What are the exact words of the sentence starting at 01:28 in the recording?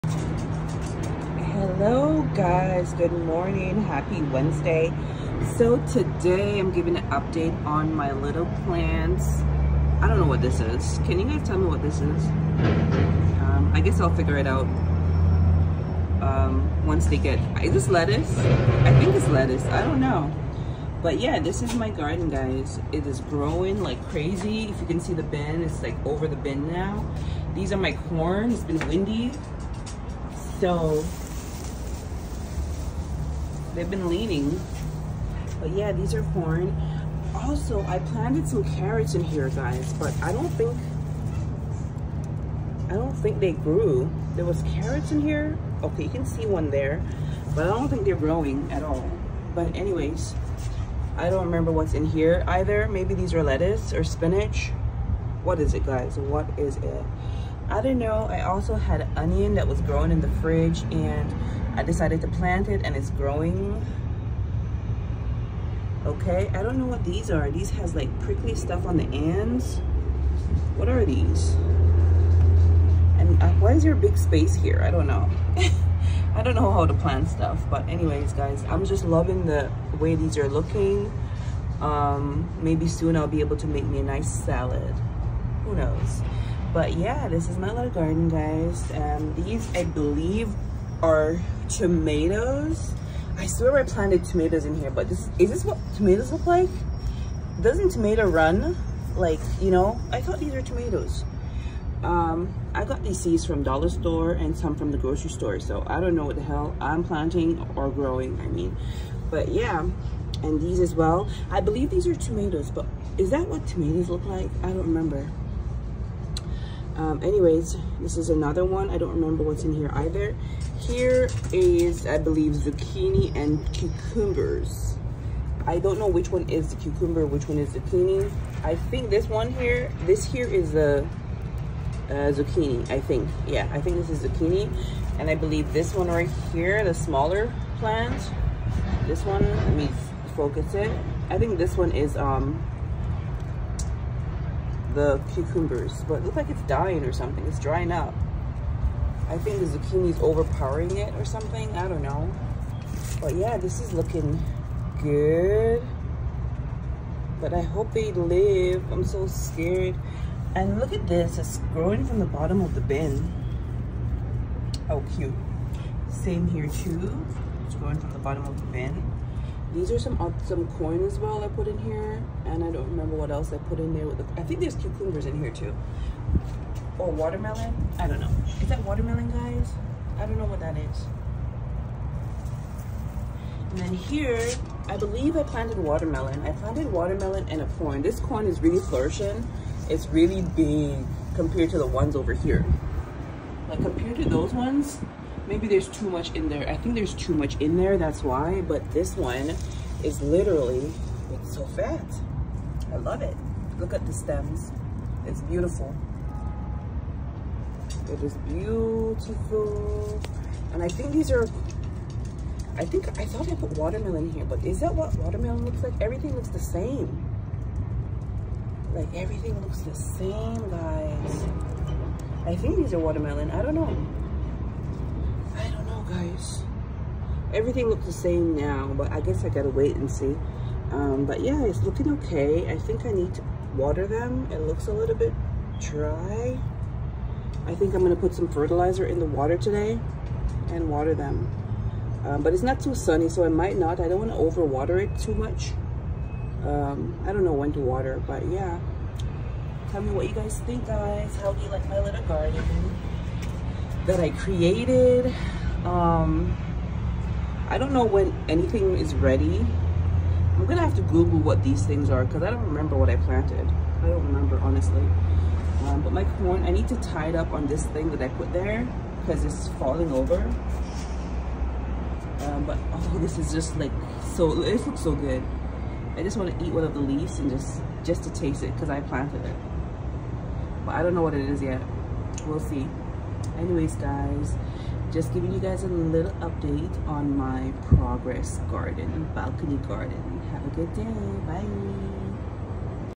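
And these, I believe, are tomatoes.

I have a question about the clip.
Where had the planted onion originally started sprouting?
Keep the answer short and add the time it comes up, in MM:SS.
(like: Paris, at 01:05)
In the fridge, at 01:00.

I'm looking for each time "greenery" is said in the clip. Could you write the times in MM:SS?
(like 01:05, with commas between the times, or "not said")
not said.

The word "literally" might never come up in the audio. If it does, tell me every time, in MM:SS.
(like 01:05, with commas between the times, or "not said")
03:20.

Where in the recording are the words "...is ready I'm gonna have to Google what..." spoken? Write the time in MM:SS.
04:18.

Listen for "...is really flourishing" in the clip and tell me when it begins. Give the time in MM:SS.
03:08.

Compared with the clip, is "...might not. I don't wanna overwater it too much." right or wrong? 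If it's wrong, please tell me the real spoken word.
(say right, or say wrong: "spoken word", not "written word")
right.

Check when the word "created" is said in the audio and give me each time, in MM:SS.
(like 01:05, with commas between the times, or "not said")
04:14.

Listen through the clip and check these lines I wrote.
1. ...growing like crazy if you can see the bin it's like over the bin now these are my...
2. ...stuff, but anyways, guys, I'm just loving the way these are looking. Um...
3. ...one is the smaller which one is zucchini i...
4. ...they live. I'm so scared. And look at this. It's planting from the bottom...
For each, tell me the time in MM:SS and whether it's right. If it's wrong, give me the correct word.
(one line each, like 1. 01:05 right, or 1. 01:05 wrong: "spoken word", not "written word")
1. 00:23 right
2. 01:17 right
3. 02:06 wrong: "cucumber", not "smaller"
4. 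02:37 wrong: "growing", not "planting".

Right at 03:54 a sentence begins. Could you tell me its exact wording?
It looks a little bit dry.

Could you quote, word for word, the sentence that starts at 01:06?
Okay, I don't know what these are.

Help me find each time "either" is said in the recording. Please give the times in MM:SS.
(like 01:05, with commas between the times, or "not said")
00:52, 01:59.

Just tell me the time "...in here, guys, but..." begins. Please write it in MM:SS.
00:39.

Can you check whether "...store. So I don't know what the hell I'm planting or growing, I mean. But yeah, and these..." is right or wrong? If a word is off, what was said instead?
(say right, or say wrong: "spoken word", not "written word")
right.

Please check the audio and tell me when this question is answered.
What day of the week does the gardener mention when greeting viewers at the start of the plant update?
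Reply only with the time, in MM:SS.
00:04.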